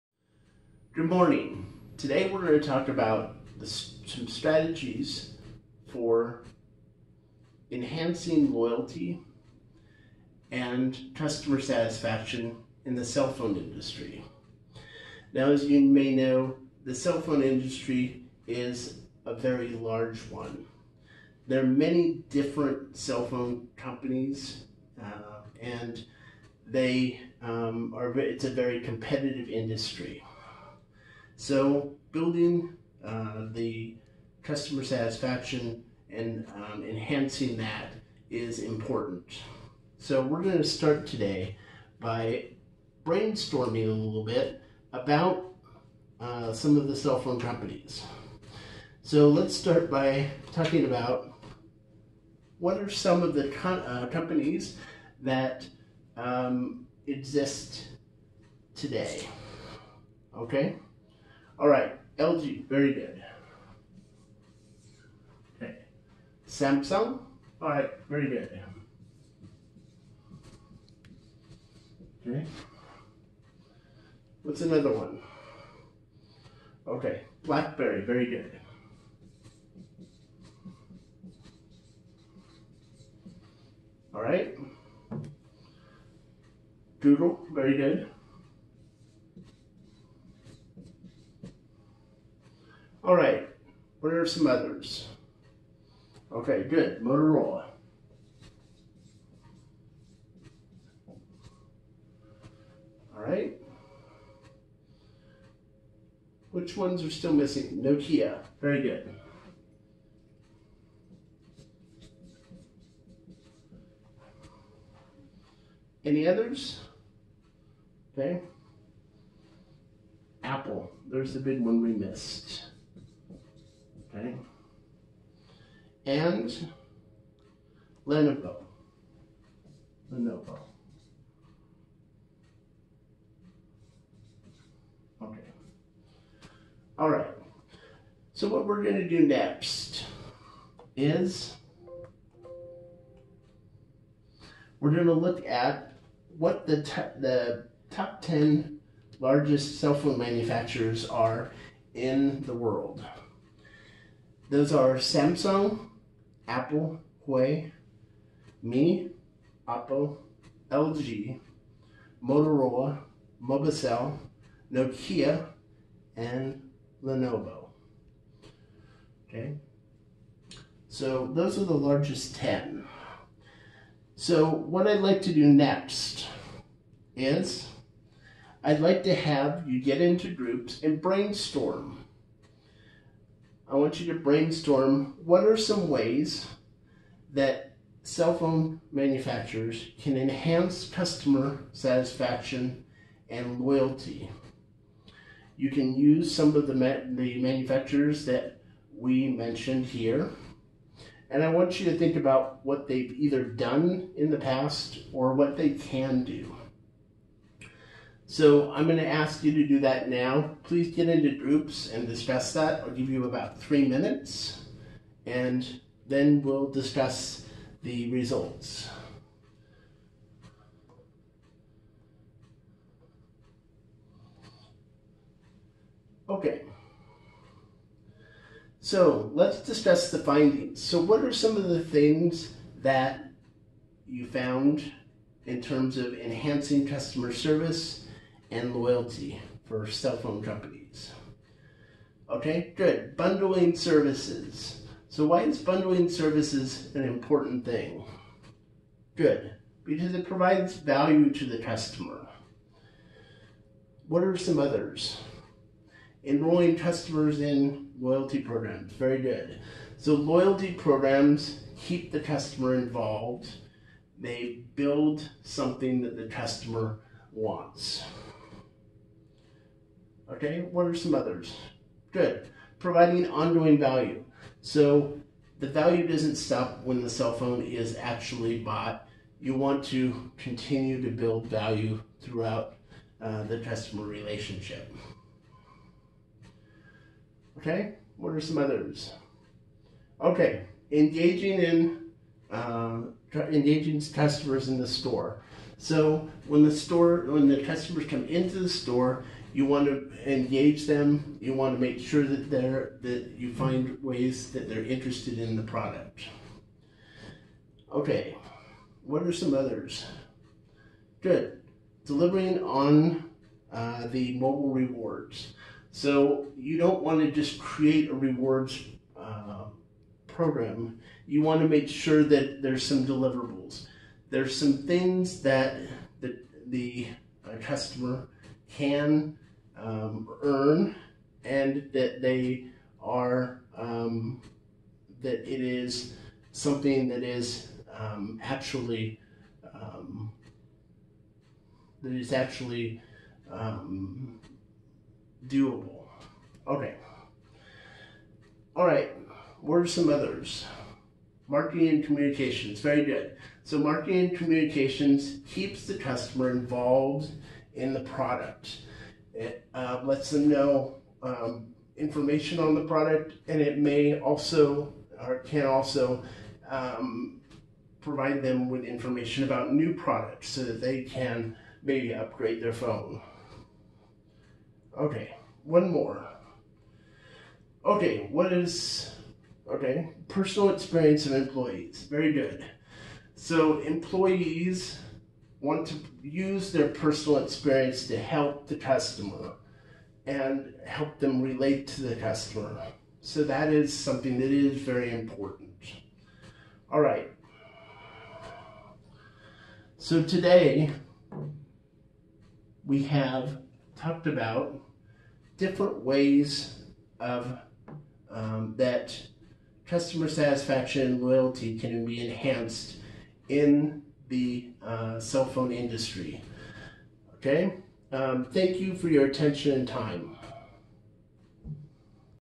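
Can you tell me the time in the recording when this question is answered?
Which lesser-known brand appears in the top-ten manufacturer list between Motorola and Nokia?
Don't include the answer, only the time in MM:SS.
02:43.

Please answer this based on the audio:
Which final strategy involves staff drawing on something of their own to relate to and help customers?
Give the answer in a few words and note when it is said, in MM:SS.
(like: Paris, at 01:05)
Personal experience of employees, at 06:20.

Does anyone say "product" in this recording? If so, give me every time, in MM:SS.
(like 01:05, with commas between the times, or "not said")
05:05, 05:58, 06:02, 06:09.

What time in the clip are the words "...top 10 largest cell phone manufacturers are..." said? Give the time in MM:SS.
02:27.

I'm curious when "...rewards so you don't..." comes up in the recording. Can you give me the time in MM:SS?
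05:14.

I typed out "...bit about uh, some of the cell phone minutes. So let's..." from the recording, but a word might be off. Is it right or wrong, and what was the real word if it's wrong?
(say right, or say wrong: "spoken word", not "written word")
wrong: "companies", not "minutes".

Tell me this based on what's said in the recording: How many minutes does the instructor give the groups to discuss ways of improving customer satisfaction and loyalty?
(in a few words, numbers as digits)
3.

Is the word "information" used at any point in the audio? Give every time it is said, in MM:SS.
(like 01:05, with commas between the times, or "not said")
06:01, 06:08.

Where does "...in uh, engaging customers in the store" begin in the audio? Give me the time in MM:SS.
04:51.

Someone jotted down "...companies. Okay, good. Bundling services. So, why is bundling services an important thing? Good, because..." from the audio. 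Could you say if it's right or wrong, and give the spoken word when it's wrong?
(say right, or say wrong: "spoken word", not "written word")
right.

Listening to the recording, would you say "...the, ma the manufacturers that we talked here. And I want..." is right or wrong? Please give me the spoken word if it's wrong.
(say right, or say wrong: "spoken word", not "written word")
wrong: "mentioned", not "talked".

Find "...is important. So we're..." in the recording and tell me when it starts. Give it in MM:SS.
00:38.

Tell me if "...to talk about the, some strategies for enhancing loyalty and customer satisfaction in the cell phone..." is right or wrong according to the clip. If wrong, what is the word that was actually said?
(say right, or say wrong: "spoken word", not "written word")
right.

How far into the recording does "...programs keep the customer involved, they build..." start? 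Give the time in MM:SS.
04:20.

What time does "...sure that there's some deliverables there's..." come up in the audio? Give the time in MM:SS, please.
05:21.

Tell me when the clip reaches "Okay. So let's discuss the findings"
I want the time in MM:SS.
03:46.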